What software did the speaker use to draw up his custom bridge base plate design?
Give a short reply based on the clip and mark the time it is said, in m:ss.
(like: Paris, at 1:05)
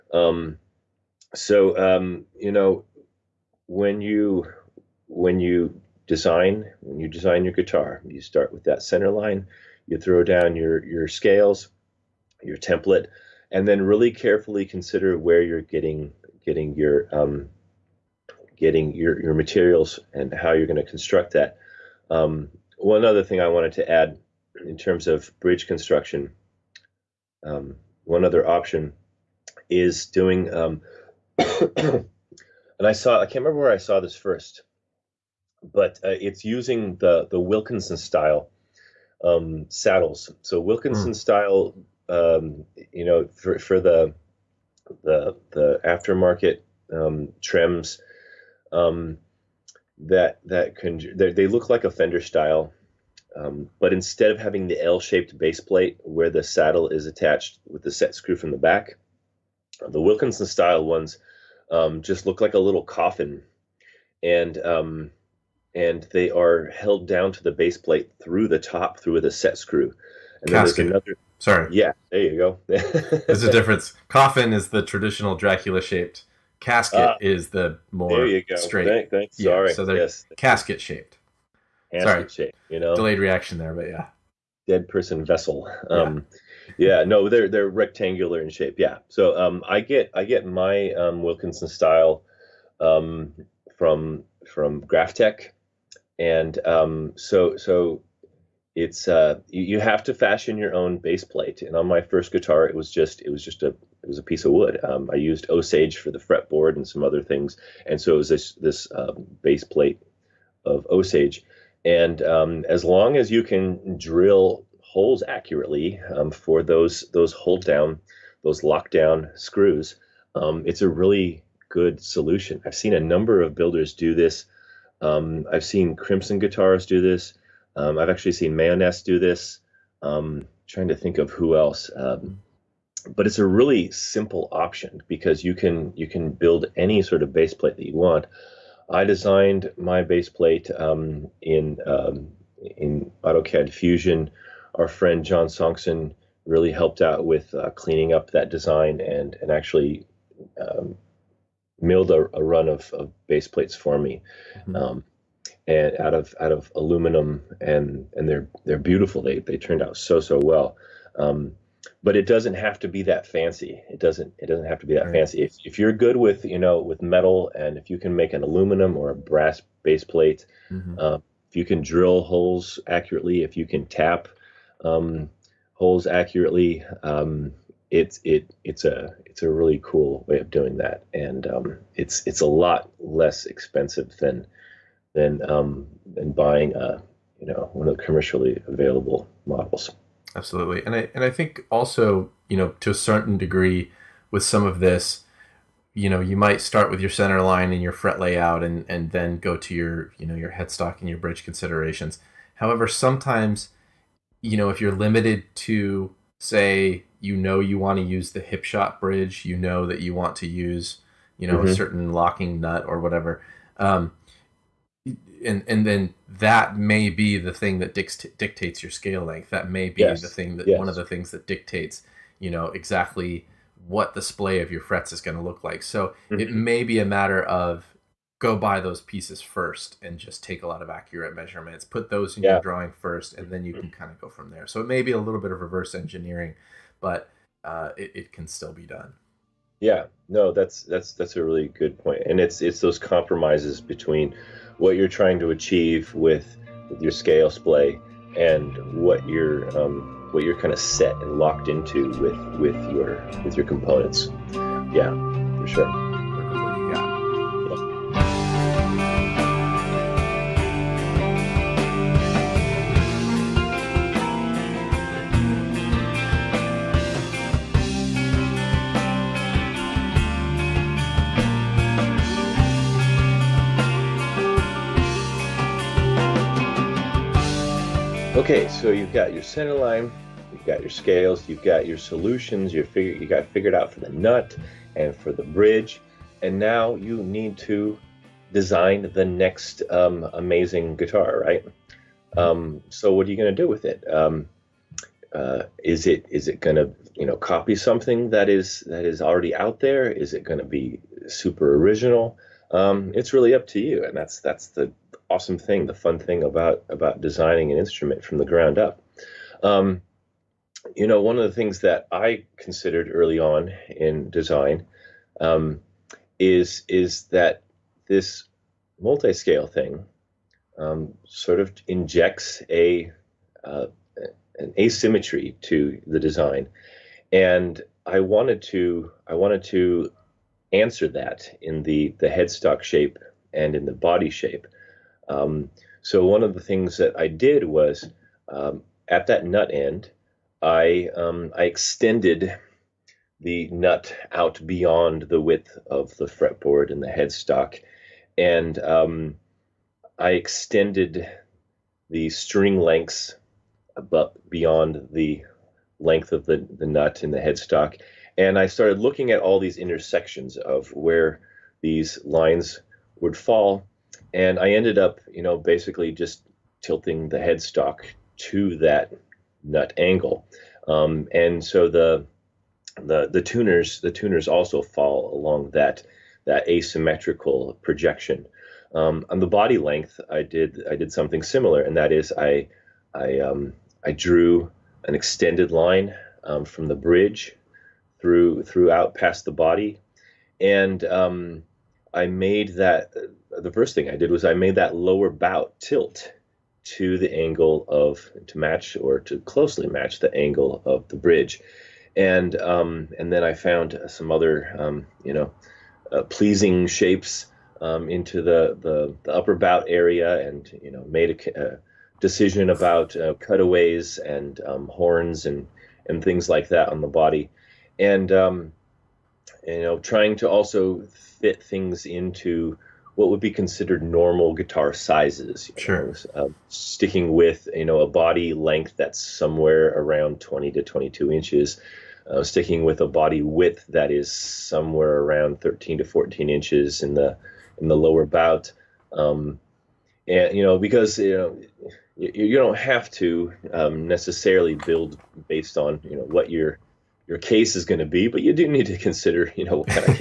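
AutoCAD Fusion, at 2:23.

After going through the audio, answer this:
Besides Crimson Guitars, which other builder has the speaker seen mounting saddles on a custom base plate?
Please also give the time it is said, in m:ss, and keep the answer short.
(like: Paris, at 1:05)
Mayones, at 2:08.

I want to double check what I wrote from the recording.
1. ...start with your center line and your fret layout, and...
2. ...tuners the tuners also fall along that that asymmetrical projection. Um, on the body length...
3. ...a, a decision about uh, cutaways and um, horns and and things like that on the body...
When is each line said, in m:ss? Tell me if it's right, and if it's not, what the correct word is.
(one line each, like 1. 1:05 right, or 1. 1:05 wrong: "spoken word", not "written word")
1. 3:16 right
2. 6:13 right
3. 6:51 right.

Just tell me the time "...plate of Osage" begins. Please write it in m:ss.
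1:49.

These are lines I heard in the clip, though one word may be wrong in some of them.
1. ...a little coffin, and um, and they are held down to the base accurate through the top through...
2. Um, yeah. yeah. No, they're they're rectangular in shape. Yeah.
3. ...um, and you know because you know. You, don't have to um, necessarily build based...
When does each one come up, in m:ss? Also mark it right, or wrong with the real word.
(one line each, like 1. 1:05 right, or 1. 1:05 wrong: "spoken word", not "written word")
1. 1:02 wrong: "plate", not "accurate"
2. 1:25 right
3. 7:19 right.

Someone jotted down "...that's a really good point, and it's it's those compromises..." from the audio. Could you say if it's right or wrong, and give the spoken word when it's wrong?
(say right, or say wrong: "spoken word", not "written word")
right.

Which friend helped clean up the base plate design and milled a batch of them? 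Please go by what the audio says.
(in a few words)
John Songson.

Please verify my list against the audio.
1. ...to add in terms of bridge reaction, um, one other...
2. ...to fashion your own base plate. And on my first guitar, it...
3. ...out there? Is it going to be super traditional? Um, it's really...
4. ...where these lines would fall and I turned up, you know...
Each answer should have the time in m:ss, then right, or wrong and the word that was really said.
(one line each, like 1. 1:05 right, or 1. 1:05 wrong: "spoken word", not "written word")
1. 0:23 wrong: "construction", not "reaction"
2. 1:40 right
3. 4:59 wrong: "original", not "traditional"
4. 6:00 wrong: "ended", not "turned".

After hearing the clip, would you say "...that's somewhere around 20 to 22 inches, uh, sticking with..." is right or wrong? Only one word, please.
right.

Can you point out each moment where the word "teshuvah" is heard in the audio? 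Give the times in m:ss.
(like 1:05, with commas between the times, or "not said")
not said.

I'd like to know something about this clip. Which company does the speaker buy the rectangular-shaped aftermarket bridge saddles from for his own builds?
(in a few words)
Graphtech.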